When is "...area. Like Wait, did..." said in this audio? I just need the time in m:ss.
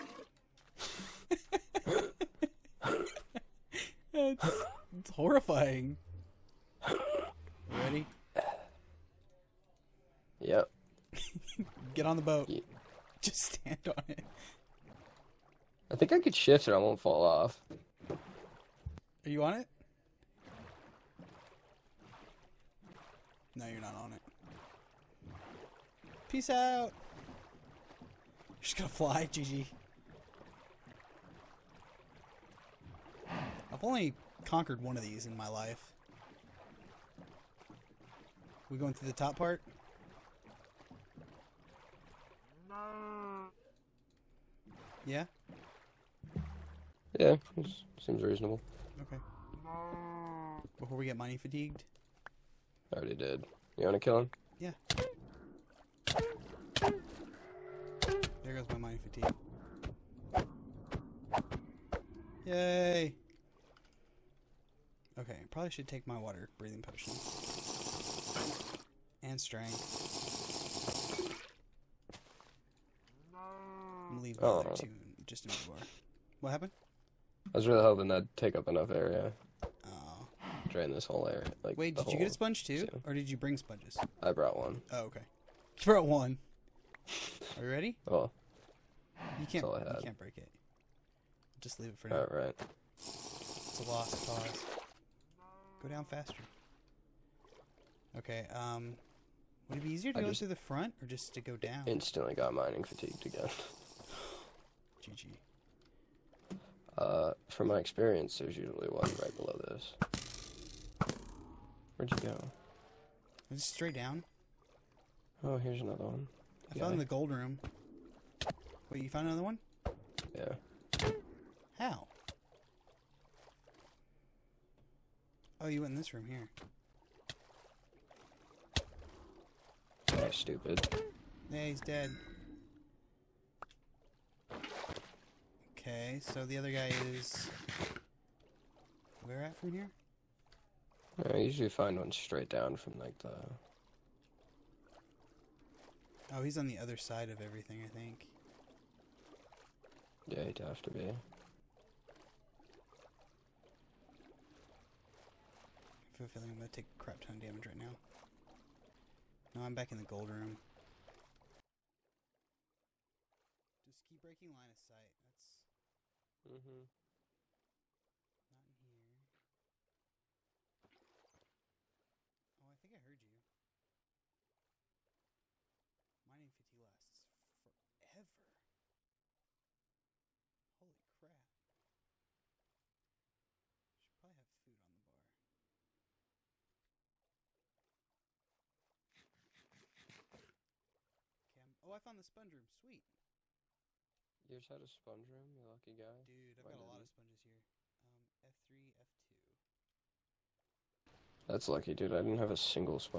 1:21.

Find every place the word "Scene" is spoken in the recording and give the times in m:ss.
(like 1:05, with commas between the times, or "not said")
1:22.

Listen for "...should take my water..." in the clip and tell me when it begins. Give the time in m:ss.
1:05.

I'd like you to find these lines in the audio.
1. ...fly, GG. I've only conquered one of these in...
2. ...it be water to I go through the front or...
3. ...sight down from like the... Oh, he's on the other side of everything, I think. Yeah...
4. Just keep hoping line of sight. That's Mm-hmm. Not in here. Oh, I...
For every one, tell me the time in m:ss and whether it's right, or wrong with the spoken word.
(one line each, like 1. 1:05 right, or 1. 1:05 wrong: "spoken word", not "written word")
1. 0:28 right
2. 1:39 wrong: "easier", not "water"
3. 2:22 wrong: "straight", not "sight"
4. 2:43 wrong: "breaking", not "hoping".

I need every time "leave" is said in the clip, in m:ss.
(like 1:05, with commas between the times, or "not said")
1:14, 1:31.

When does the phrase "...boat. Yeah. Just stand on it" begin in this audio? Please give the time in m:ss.
0:12.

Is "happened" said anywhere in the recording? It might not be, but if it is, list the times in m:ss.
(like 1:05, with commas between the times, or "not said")
1:16.